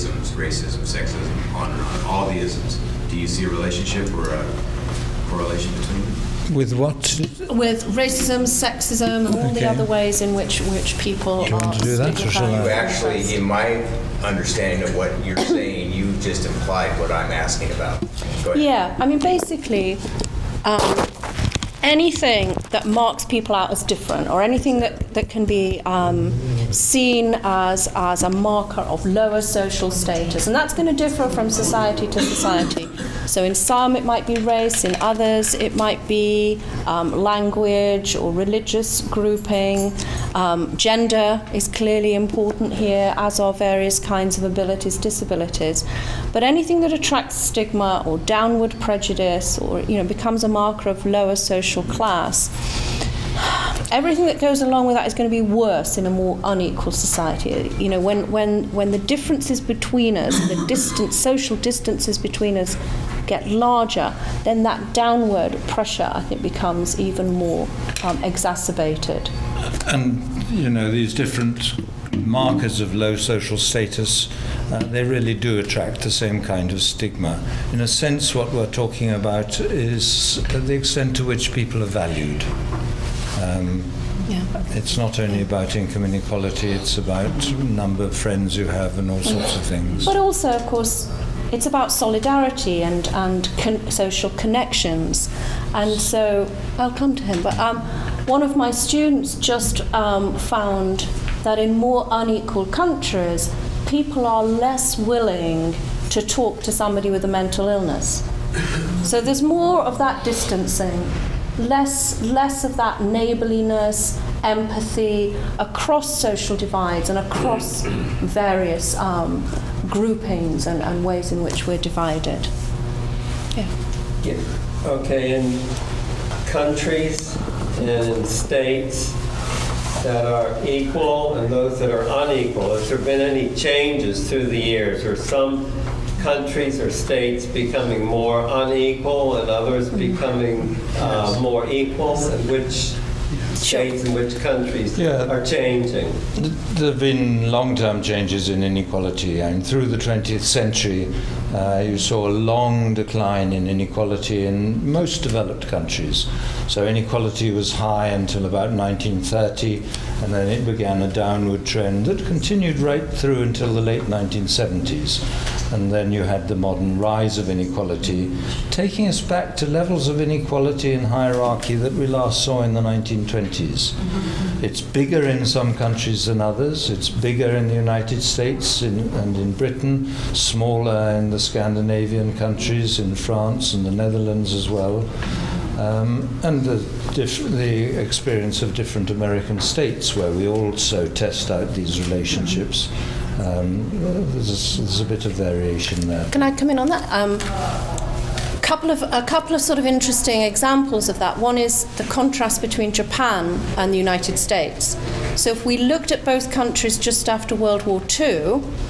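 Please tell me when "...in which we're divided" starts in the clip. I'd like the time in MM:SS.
02:01.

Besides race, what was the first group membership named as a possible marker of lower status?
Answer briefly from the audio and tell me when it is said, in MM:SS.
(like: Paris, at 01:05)
language, at 00:37.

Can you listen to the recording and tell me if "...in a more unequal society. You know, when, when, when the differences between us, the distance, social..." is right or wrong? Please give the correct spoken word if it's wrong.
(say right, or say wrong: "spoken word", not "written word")
right.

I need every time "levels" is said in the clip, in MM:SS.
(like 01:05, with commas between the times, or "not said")
02:49.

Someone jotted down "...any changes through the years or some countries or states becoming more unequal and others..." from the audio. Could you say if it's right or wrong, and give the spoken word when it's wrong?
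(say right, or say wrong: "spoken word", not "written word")
right.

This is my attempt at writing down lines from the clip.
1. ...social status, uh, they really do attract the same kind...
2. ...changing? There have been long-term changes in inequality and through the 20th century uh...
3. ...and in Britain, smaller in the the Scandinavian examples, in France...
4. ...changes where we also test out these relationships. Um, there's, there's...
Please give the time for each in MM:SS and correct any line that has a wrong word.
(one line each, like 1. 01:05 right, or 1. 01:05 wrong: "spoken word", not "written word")
1. 01:13 right
2. 02:25 right
3. 02:59 wrong: "countries", not "examples"
4. 03:09 wrong: "states", not "changes".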